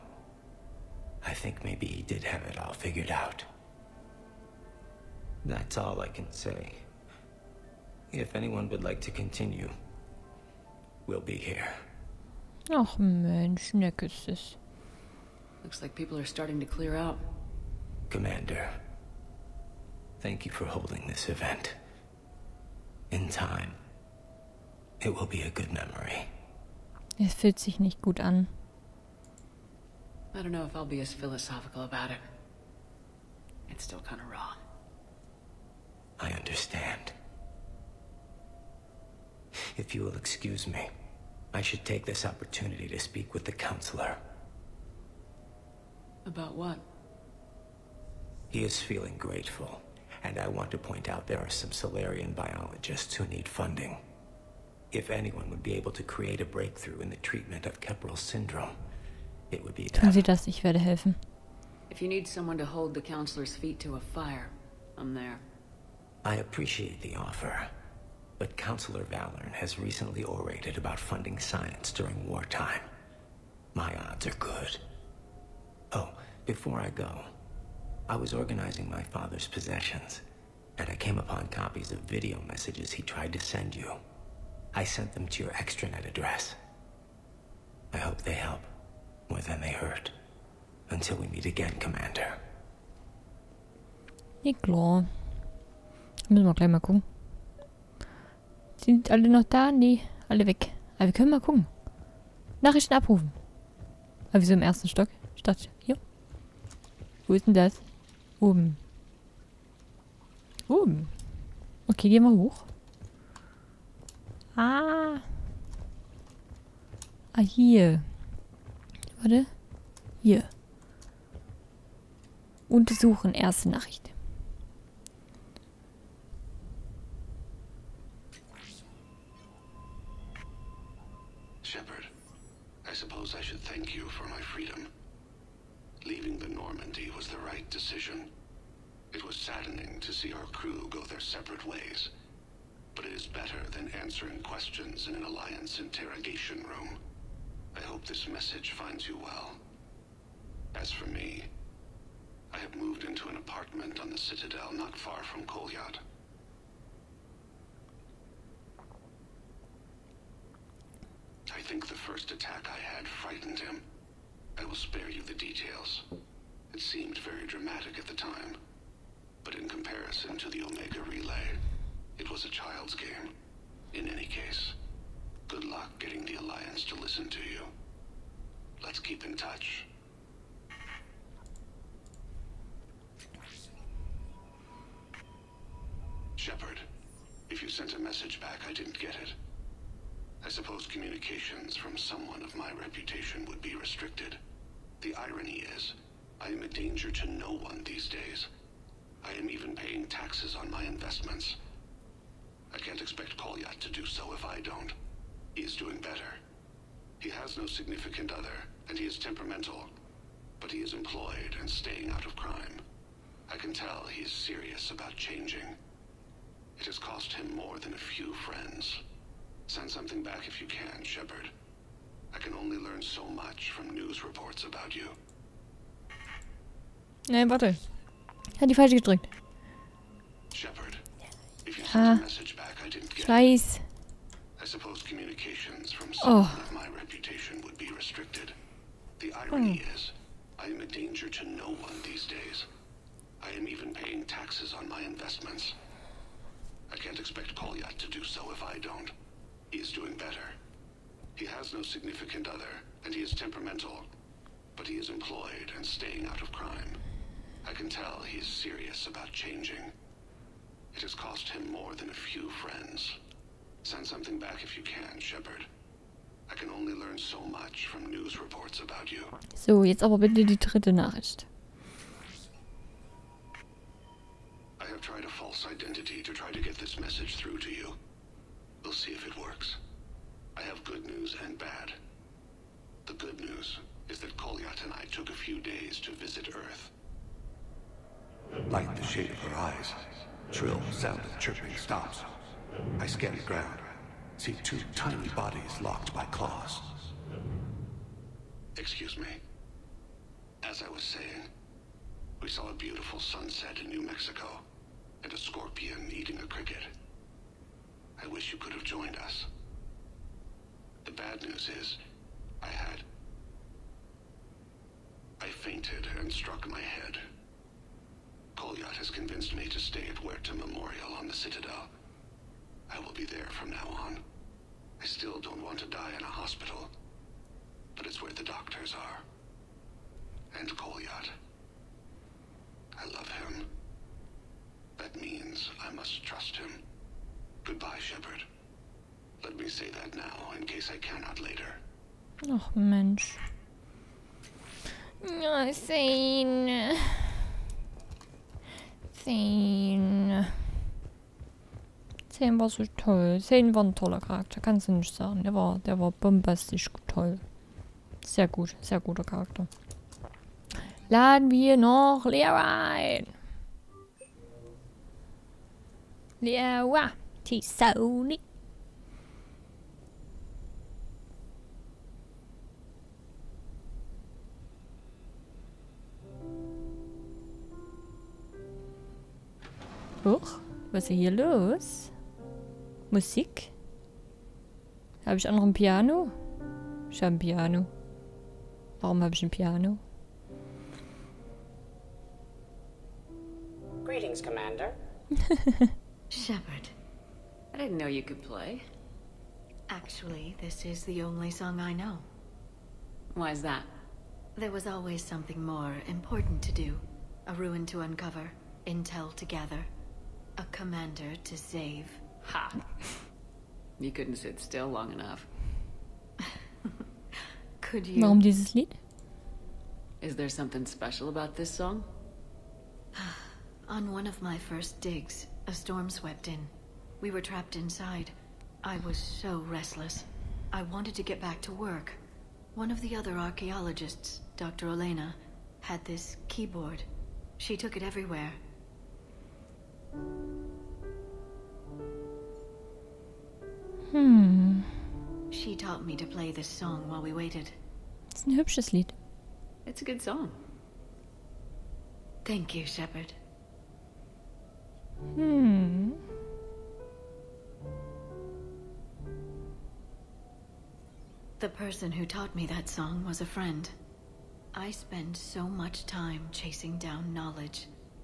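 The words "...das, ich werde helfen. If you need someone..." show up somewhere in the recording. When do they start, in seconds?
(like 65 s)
60 s.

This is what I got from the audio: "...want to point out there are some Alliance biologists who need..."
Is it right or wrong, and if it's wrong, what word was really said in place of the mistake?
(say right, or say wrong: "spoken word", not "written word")
wrong: "Salarian", not "Alliance".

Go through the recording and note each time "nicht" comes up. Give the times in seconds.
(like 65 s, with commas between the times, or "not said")
27 s, 354 s.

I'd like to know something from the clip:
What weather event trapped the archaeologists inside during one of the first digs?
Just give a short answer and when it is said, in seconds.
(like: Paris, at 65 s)
A storm, at 425 s.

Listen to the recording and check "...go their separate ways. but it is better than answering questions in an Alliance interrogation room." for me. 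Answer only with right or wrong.
right.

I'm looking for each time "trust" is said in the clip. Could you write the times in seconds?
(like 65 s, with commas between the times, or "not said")
336 s.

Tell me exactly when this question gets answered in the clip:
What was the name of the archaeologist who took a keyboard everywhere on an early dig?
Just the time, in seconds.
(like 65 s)
434 s.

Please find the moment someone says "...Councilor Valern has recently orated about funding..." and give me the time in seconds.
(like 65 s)
68 s.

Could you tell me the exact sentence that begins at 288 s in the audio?
Like the shade of her eyes, trill sound of chirping stops.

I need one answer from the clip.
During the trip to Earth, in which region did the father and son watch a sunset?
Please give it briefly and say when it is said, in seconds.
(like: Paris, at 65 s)
New Mexico, at 303 s.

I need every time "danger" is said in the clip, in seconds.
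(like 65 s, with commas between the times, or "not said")
196 s, 240 s.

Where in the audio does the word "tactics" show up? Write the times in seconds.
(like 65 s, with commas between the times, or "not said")
not said.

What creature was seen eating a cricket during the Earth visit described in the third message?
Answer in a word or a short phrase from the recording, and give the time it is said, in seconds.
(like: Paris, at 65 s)
A scorpion, at 305 s.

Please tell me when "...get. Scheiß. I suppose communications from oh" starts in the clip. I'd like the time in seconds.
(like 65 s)
233 s.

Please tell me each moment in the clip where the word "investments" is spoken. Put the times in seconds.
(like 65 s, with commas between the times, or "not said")
200 s, 245 s.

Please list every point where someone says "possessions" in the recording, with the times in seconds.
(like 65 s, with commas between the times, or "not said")
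79 s.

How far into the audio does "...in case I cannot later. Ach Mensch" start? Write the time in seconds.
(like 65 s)
340 s.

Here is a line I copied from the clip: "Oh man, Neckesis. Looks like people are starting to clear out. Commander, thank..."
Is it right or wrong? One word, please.
right.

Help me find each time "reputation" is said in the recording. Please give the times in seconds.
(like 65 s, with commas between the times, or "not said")
192 s, 236 s.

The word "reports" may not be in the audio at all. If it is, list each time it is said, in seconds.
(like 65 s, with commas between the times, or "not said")
224 s, 268 s.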